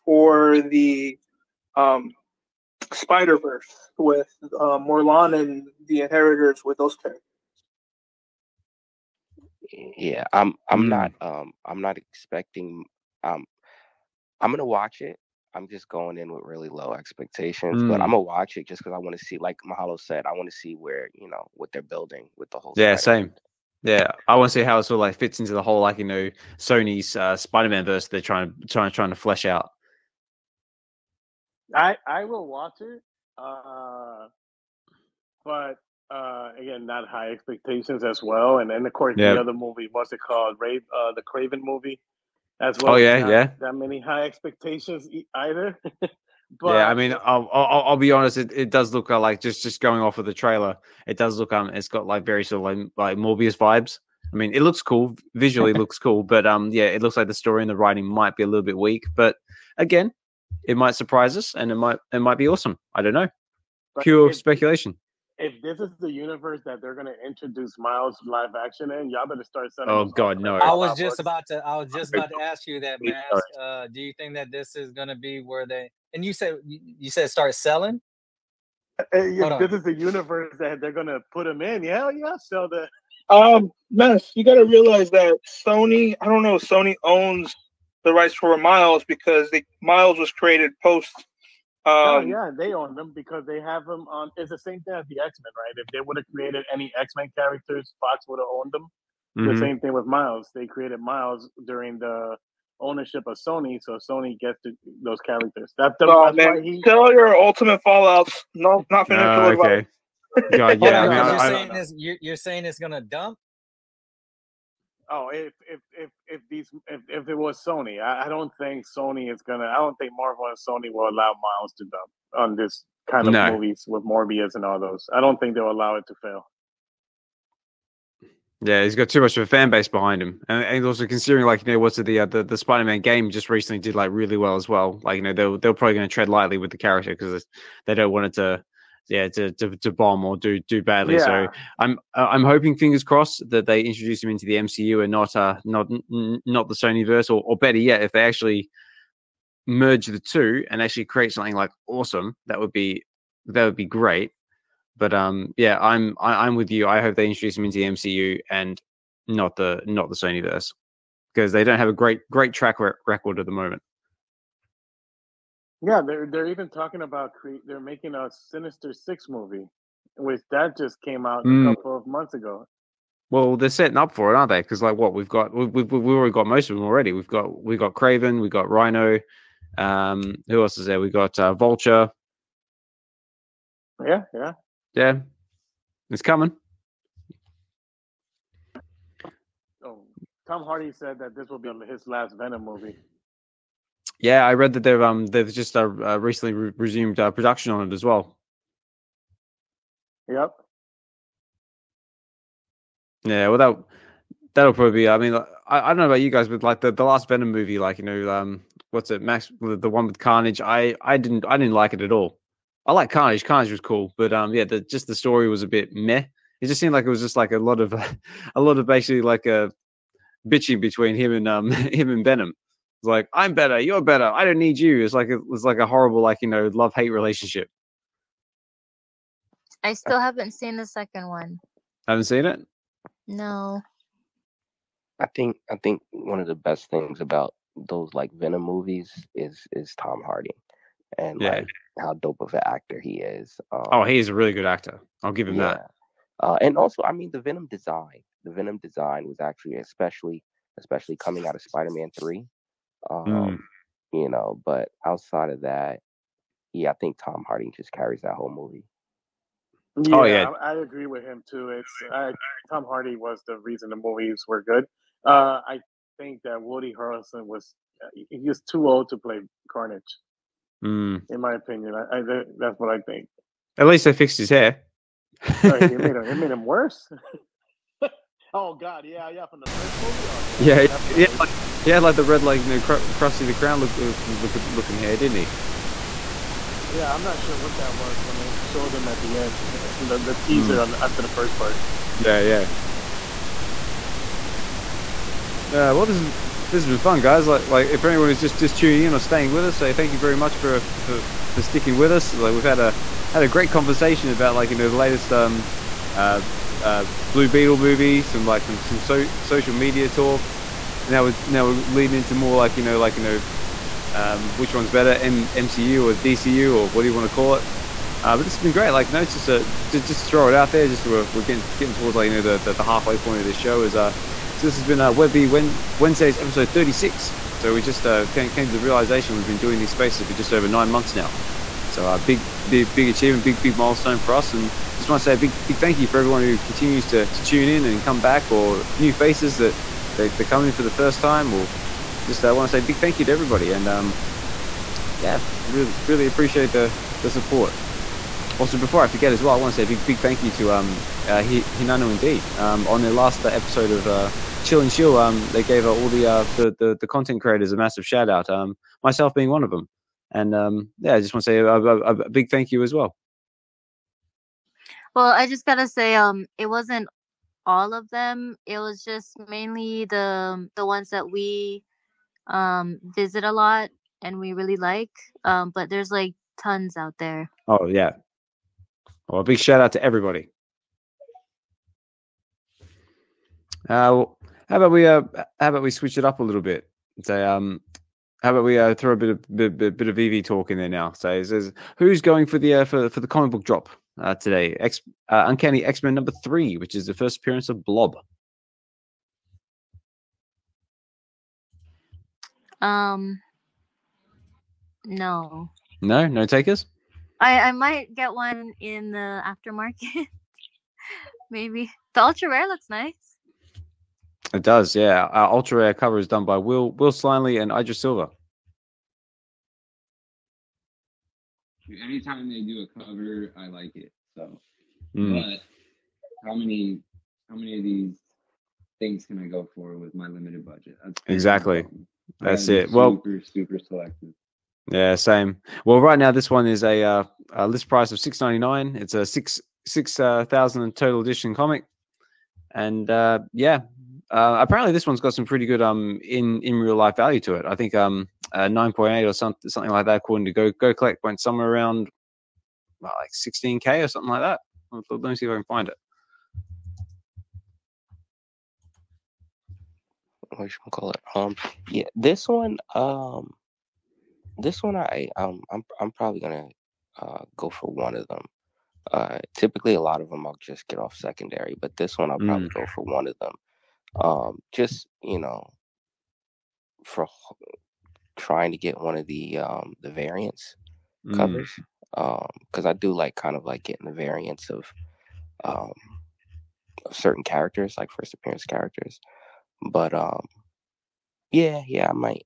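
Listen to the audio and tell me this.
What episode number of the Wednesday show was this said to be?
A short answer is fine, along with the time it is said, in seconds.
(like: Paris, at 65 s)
36, at 326 s.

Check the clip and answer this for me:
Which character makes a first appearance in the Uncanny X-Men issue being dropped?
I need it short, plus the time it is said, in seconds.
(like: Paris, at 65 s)
Blob, at 397 s.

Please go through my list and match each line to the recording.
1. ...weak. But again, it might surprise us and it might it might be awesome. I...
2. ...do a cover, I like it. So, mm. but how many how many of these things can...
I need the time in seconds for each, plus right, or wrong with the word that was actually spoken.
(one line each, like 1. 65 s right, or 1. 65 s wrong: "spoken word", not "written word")
1. 58 s right
2. 422 s right.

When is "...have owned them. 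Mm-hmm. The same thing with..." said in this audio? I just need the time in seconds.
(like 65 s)
98 s.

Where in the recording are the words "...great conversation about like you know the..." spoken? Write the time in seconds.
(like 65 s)
303 s.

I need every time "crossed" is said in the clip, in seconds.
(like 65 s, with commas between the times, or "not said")
143 s.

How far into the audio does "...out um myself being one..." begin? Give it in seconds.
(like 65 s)
358 s.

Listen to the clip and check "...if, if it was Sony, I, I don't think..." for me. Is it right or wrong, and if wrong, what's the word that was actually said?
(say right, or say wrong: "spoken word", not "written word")
right.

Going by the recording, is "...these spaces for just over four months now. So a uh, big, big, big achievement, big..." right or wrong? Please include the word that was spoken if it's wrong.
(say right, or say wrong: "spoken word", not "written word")
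wrong: "nine", not "four".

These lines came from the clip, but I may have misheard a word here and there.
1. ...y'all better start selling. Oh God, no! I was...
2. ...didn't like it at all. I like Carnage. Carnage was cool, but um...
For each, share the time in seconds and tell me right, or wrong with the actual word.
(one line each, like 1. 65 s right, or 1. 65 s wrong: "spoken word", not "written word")
1. 69 s right
2. 211 s right.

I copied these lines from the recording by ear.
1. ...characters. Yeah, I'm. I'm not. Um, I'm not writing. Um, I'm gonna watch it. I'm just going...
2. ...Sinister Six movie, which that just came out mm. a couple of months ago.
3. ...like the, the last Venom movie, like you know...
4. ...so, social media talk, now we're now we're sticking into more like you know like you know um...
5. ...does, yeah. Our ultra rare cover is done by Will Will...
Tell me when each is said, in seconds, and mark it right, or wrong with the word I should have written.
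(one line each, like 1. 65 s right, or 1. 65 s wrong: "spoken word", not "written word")
1. 6 s wrong: "expecting", not "writing"
2. 168 s right
3. 206 s right
4. 308 s wrong: "leading", not "sticking"
5. 414 s right.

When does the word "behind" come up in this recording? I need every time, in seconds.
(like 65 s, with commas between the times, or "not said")
129 s.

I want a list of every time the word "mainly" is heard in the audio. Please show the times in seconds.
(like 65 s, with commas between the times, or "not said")
369 s.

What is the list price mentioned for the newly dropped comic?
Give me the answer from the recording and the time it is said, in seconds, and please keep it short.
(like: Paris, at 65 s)
6.99, at 438 s.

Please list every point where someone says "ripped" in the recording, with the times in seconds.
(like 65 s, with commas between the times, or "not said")
not said.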